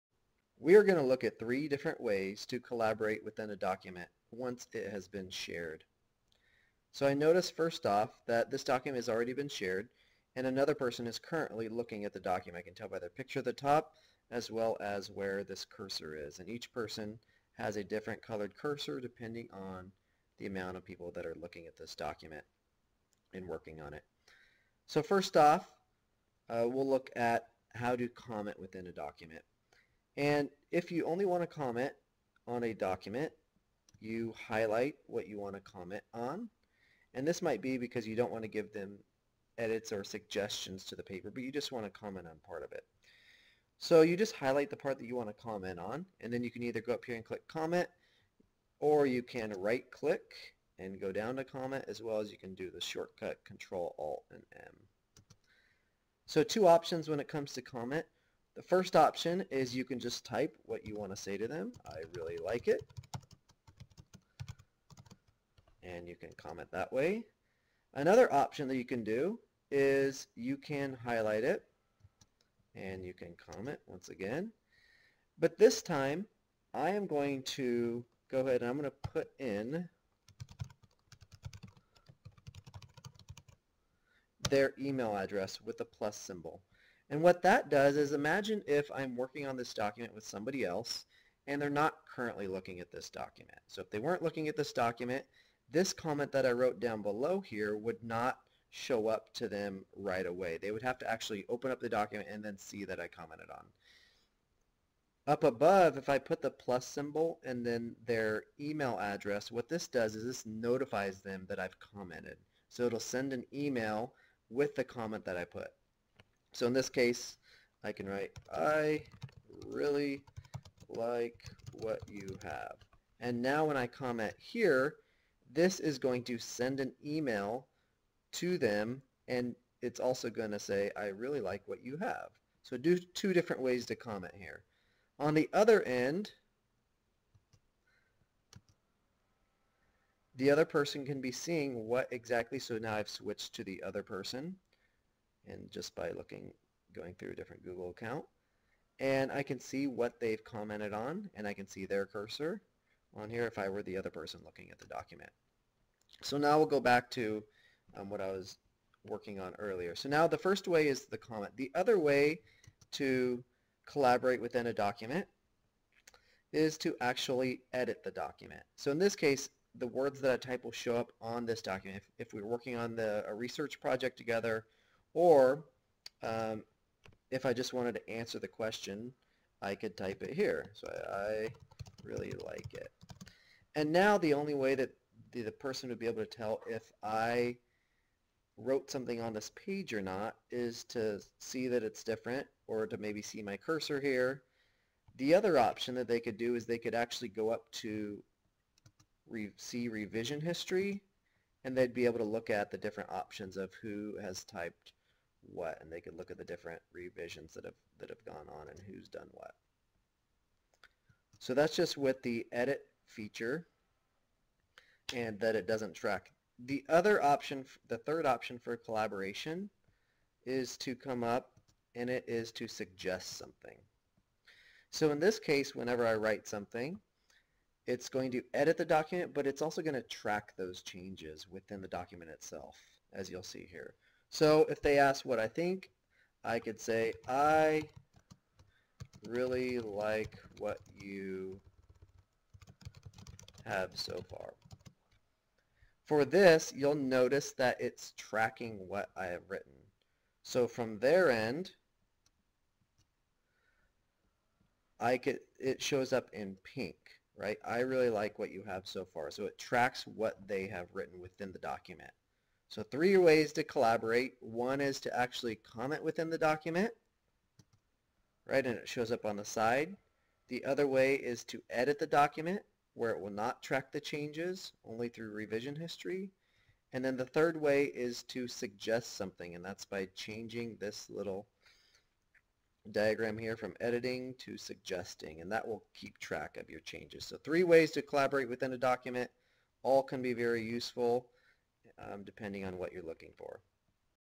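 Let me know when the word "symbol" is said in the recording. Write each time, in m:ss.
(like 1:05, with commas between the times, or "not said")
1:26, 1:46.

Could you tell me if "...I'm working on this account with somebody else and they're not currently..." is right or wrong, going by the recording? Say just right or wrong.
wrong.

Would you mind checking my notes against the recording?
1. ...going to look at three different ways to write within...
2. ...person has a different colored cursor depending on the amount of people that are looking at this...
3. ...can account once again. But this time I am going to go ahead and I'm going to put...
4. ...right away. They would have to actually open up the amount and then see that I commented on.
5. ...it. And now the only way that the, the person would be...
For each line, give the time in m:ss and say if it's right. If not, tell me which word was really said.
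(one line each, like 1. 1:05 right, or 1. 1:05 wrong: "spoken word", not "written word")
1. 0:00 wrong: "collaborate", not "write"
2. 0:16 right
3. 1:13 wrong: "comment", not "account"
4. 1:39 wrong: "document", not "amount"
5. 3:02 right.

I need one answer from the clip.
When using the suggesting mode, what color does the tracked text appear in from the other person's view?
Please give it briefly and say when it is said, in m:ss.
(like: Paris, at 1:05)
pink, at 4:16.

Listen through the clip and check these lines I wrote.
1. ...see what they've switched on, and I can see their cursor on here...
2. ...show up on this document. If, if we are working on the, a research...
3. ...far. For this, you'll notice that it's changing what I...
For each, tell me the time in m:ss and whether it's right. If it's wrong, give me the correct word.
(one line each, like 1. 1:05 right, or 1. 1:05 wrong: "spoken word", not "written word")
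1. 2:29 wrong: "commented", not "switched"
2. 2:50 right
3. 4:04 wrong: "tracking", not "changing".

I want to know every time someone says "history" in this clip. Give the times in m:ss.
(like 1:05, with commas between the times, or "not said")
3:20, 4:35.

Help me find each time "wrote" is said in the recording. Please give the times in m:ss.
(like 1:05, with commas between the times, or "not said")
1:36, 3:08.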